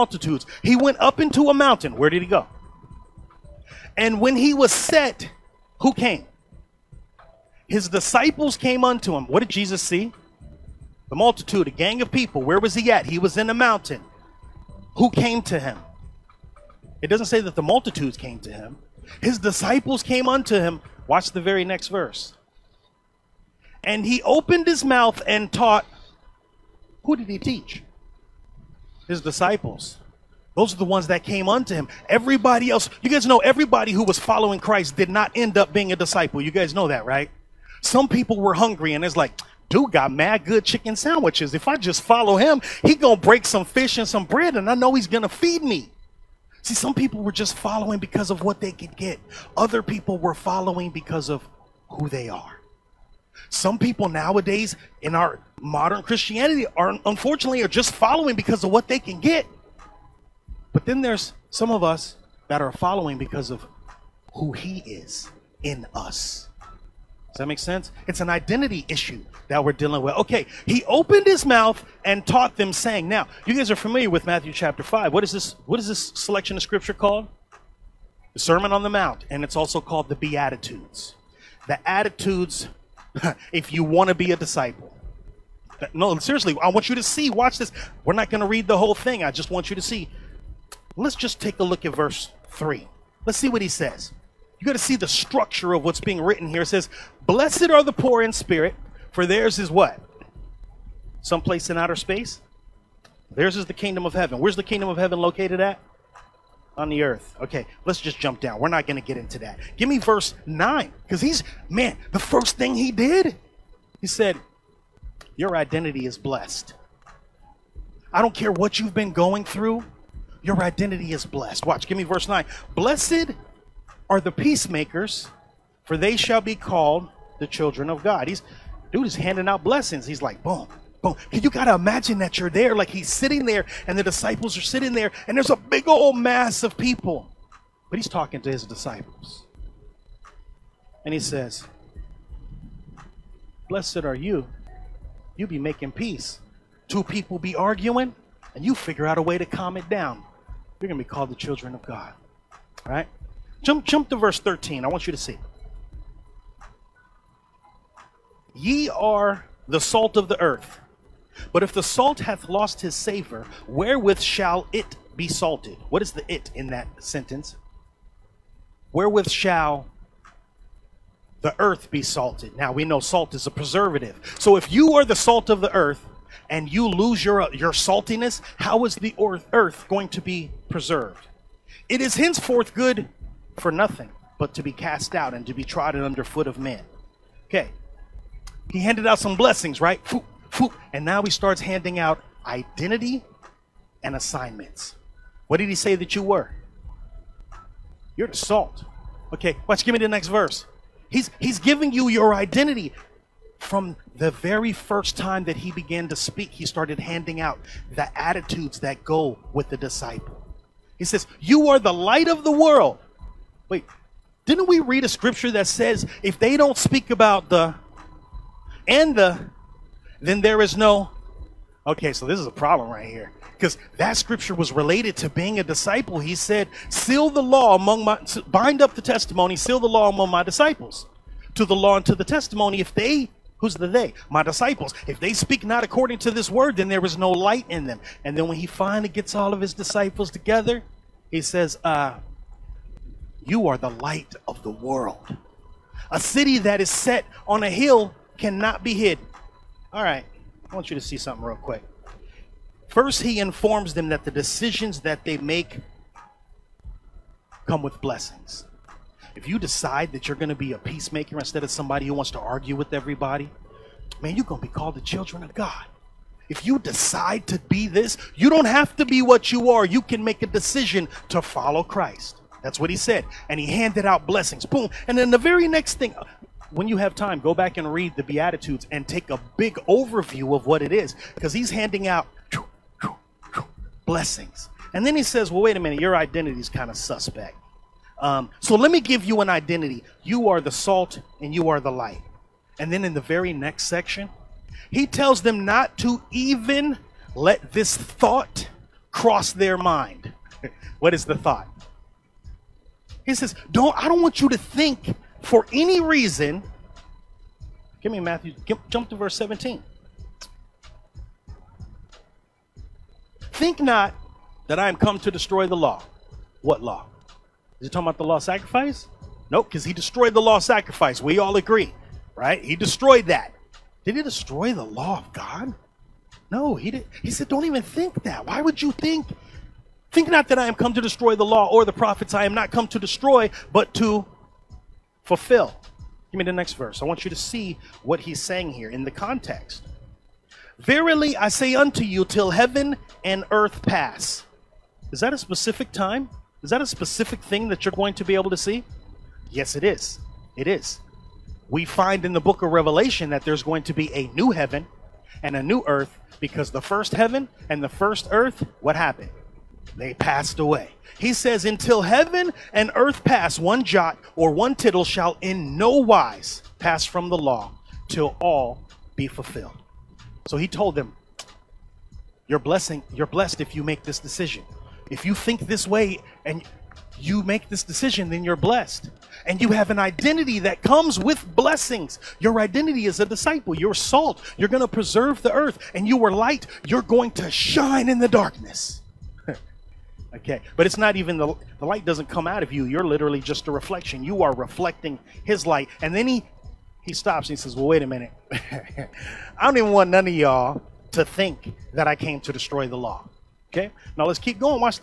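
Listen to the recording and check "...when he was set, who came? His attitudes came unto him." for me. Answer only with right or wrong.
wrong.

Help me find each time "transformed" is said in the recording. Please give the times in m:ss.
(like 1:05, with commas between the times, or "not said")
not said.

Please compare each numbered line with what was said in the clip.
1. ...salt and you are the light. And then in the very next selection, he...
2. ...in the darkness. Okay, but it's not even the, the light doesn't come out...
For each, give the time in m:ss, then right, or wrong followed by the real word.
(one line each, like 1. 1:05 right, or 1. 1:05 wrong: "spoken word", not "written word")
1. 4:50 wrong: "section", not "selection"
2. 6:28 right.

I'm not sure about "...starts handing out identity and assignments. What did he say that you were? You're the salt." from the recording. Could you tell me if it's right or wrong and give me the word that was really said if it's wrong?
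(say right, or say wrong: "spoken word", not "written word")
right.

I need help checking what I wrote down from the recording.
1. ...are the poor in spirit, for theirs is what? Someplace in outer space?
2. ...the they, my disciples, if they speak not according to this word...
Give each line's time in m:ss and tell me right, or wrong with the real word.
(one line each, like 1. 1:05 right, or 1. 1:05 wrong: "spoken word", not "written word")
1. 1:37 right
2. 3:53 right.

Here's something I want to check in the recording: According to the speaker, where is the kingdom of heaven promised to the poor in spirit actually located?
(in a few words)
On the earth.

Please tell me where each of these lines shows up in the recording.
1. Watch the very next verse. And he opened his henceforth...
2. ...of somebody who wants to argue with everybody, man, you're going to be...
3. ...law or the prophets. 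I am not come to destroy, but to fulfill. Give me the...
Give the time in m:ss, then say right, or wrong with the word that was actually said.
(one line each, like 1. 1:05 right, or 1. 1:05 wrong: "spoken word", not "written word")
1. 0:21 wrong: "mouth", not "henceforth"
2. 4:21 right
3. 5:31 right.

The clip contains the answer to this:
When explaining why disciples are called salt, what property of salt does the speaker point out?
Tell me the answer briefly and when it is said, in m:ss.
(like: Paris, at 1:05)
preservative, at 2:53.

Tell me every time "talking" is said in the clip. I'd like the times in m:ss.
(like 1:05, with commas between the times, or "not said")
2:18, 5:17.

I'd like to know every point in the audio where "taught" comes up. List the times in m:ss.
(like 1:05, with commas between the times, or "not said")
0:25, 1:12.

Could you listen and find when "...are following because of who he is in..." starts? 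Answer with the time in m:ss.
1:02.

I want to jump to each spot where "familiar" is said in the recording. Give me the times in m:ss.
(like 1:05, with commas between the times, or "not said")
1:13.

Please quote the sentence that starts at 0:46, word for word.
See, some people were just following because of what they could get.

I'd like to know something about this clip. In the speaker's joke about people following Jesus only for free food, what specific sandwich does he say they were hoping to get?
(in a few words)
chicken sandwiches.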